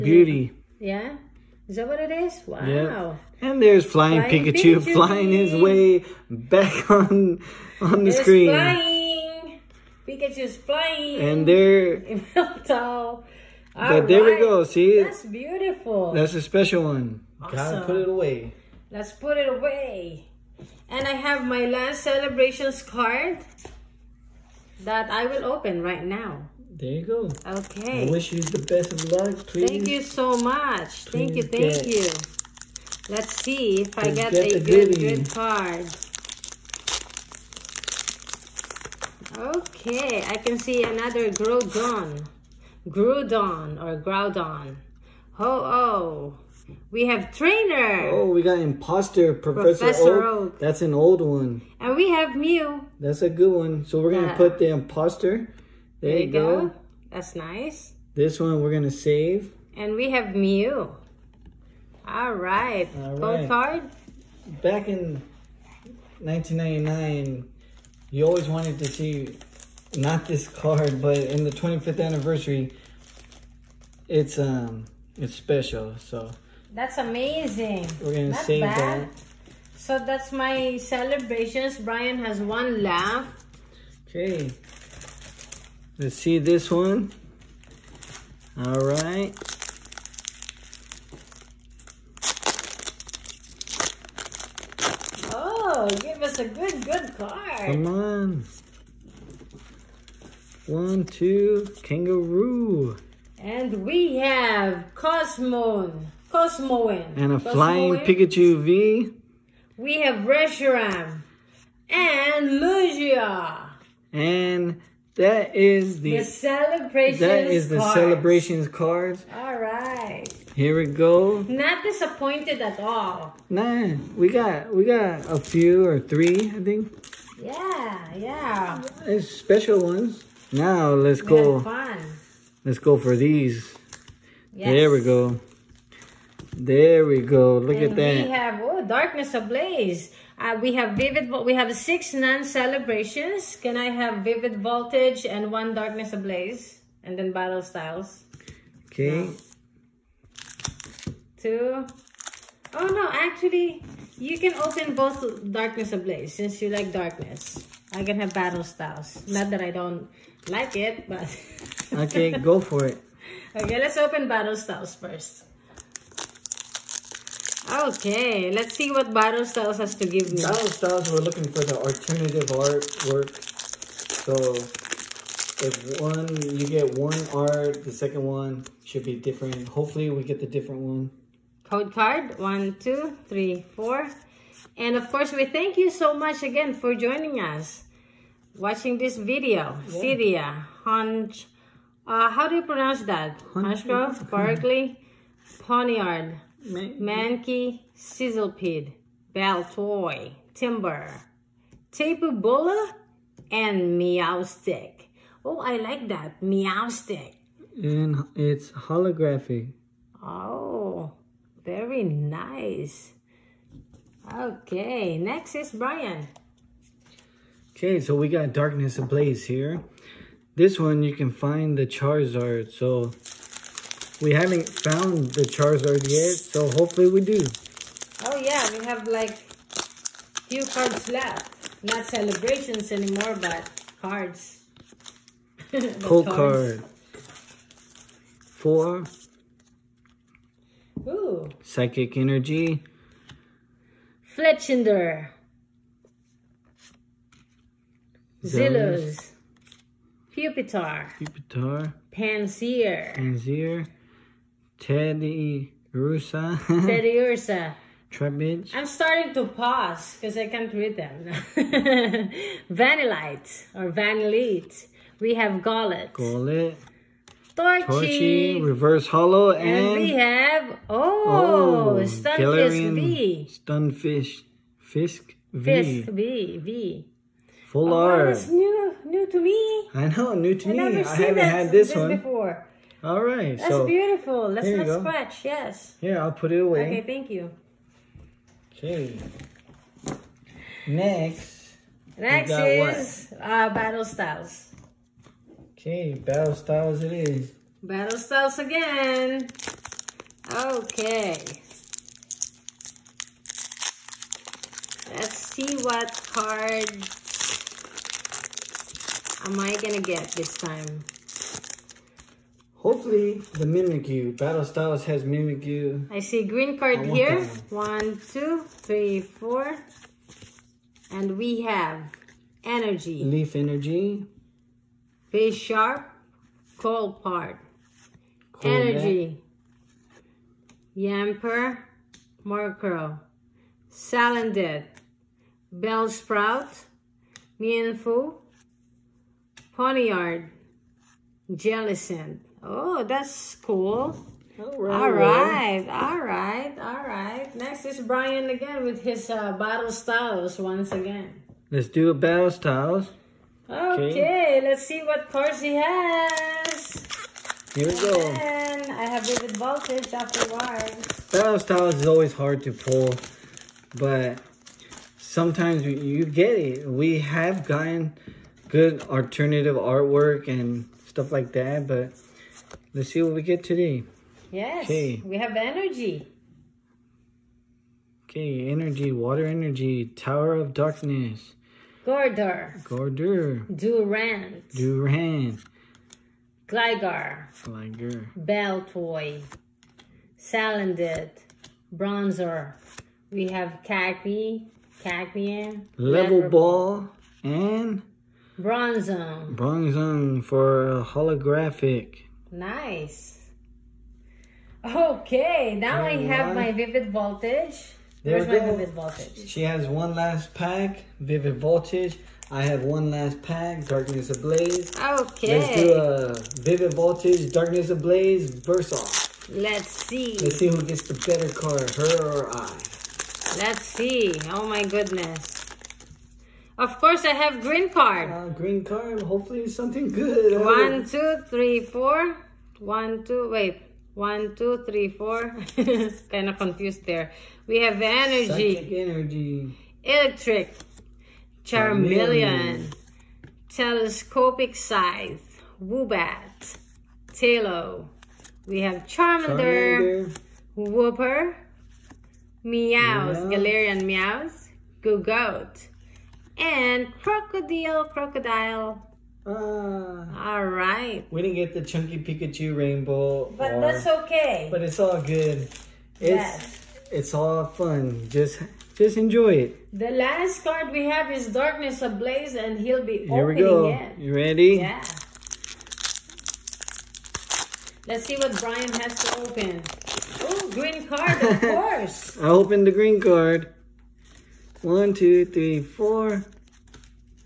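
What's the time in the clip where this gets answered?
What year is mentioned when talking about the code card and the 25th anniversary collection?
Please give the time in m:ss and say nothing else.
1:06.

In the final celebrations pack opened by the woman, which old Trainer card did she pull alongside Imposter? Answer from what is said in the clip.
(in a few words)
Professor Oak.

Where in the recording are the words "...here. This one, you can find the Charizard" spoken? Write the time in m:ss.
3:39.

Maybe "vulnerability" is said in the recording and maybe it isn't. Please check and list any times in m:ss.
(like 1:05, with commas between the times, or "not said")
not said.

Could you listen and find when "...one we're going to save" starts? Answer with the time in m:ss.
0:58.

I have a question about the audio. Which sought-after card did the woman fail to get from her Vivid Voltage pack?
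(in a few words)
chunky Pikachu rainbow.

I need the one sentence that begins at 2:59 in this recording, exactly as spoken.
Hopefully we get the different one.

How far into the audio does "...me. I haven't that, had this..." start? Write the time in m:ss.
4:40.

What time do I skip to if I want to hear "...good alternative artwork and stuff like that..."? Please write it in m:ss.
6:08.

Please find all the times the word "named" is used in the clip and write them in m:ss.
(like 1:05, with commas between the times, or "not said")
not said.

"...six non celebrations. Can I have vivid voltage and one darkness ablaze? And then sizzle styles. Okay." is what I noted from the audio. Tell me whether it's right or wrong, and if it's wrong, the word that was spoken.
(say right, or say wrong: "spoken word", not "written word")
wrong: "battle", not "sizzle".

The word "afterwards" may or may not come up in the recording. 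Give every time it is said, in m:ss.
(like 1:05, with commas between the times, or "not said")
6:00.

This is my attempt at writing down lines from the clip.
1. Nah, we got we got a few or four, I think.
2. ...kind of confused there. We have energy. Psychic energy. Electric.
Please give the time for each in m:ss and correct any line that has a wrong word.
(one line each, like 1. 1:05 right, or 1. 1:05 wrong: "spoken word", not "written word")
1. 2:03 wrong: "three", not "four"
2. 7:16 right.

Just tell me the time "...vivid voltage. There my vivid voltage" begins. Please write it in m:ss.
6:46.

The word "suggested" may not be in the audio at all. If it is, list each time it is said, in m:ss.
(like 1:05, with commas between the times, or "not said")
not said.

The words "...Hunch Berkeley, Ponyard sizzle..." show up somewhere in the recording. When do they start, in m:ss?
3:13.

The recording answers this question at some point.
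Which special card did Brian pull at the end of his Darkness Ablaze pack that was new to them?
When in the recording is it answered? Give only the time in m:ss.
4:32.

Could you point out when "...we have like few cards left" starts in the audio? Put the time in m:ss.
3:48.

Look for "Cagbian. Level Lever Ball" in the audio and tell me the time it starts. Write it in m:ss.
6:35.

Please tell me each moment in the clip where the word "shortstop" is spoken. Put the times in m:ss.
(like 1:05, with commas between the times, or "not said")
not said.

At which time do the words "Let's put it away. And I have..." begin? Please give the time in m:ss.
0:18.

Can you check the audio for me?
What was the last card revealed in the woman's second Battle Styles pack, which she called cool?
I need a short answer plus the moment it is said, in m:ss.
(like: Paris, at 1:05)
Jellicent, at 5:41.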